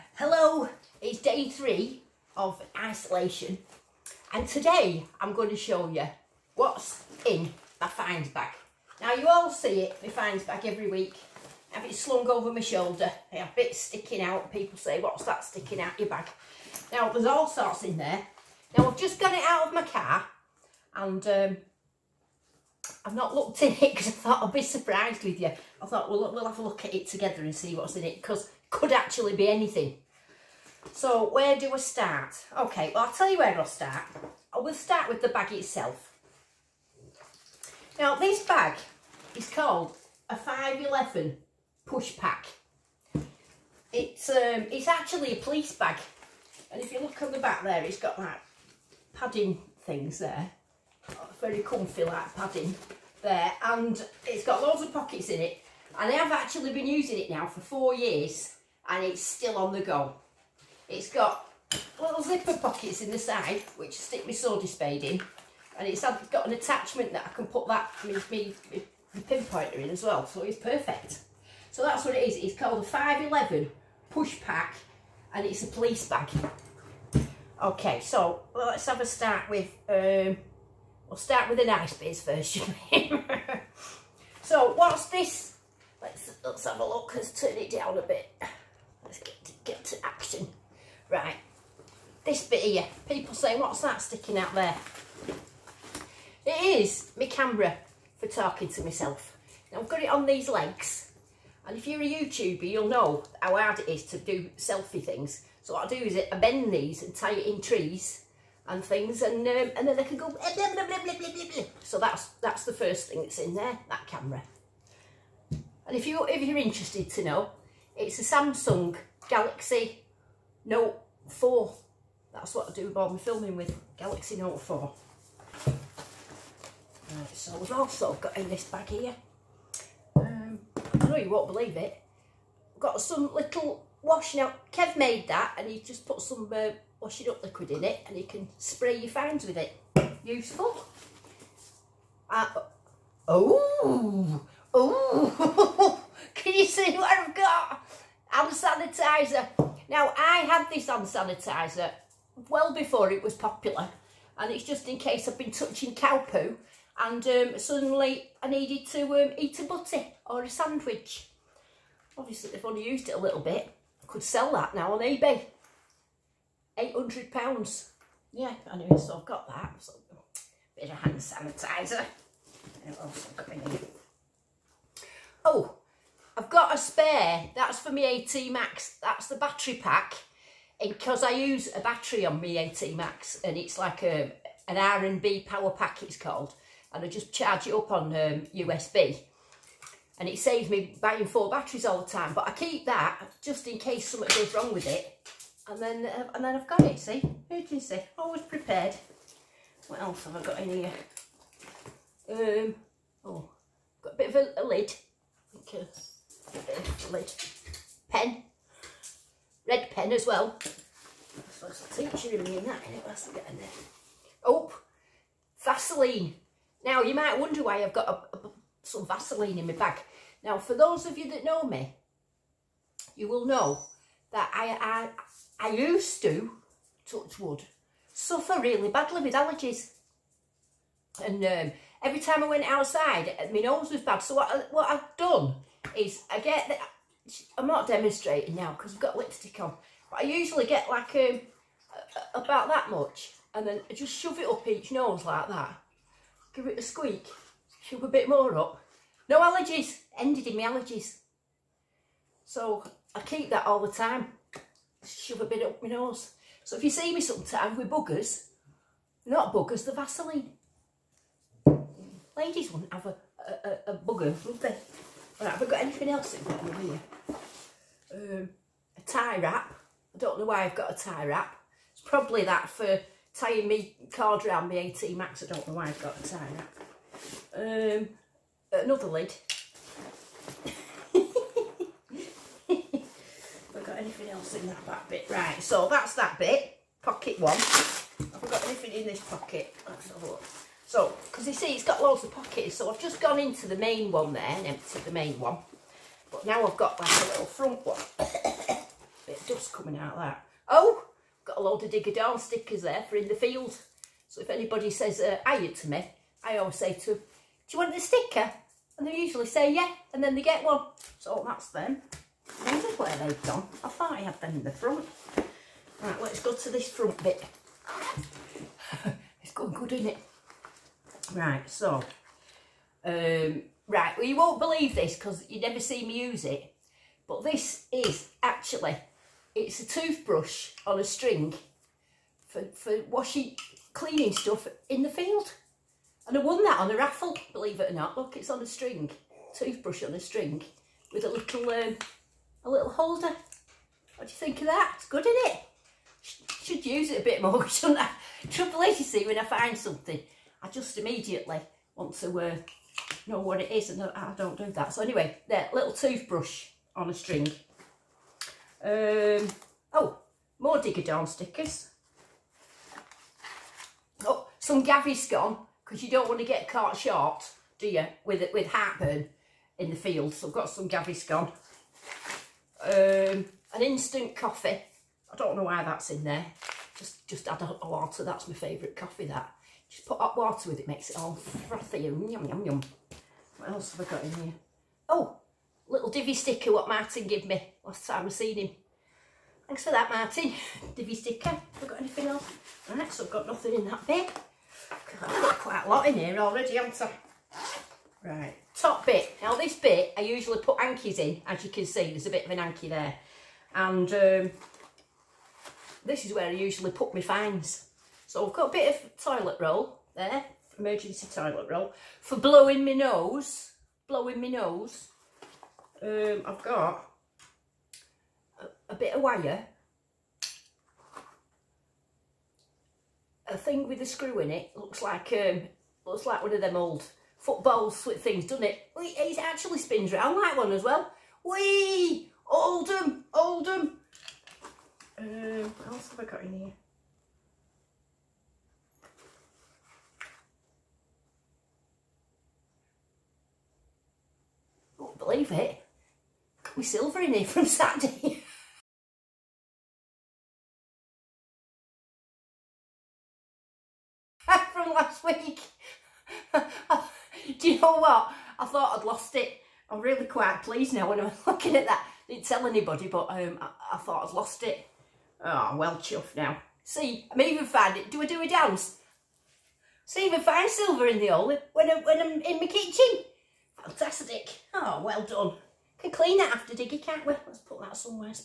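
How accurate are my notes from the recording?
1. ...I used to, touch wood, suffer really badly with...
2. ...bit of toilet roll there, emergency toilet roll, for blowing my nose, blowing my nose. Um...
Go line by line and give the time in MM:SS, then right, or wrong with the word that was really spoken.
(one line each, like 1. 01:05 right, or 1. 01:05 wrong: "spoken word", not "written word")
1. 03:45 right
2. 06:48 right.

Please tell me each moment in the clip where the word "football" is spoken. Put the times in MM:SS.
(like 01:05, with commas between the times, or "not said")
07:07.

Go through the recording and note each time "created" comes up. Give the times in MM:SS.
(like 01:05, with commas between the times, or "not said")
not said.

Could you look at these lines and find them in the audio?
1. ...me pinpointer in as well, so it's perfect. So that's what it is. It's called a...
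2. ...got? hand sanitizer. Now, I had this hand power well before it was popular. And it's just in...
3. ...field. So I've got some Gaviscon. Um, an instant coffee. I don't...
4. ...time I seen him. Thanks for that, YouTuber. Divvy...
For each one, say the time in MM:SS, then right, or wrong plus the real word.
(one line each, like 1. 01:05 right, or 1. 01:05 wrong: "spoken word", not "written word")
1. 01:08 right
2. 02:27 wrong: "sanitizer", not "power"
3. 06:09 right
4. 06:28 wrong: "Martin", not "YouTuber".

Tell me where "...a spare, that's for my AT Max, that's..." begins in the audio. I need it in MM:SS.
02:56.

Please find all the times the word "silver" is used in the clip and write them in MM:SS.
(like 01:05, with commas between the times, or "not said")
07:26, 07:50.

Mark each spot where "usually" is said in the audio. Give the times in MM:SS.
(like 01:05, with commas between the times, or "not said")
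04:00, 05:09, 06:40, 06:46.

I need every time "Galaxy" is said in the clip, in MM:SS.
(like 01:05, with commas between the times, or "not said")
01:59, 02:03.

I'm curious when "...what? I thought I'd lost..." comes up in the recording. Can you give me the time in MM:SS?
07:37.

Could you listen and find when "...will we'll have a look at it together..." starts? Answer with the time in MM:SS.
00:26.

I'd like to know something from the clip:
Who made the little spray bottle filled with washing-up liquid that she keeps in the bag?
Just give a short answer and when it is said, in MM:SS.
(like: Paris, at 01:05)
Kev, at 02:14.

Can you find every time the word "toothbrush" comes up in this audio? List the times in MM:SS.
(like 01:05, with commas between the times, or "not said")
05:29, 05:39, 05:55.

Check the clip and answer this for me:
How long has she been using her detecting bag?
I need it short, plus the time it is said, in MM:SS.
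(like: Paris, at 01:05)
4 years, at 00:57.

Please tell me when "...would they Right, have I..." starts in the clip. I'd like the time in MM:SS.
04:24.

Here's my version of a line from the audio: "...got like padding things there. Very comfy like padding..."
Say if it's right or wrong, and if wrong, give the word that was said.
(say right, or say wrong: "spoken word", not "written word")
right.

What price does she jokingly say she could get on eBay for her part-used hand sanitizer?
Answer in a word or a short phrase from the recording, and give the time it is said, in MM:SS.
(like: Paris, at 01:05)
£800, at 02:46.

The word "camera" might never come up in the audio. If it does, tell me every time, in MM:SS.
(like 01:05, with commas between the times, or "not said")
01:37, 01:54.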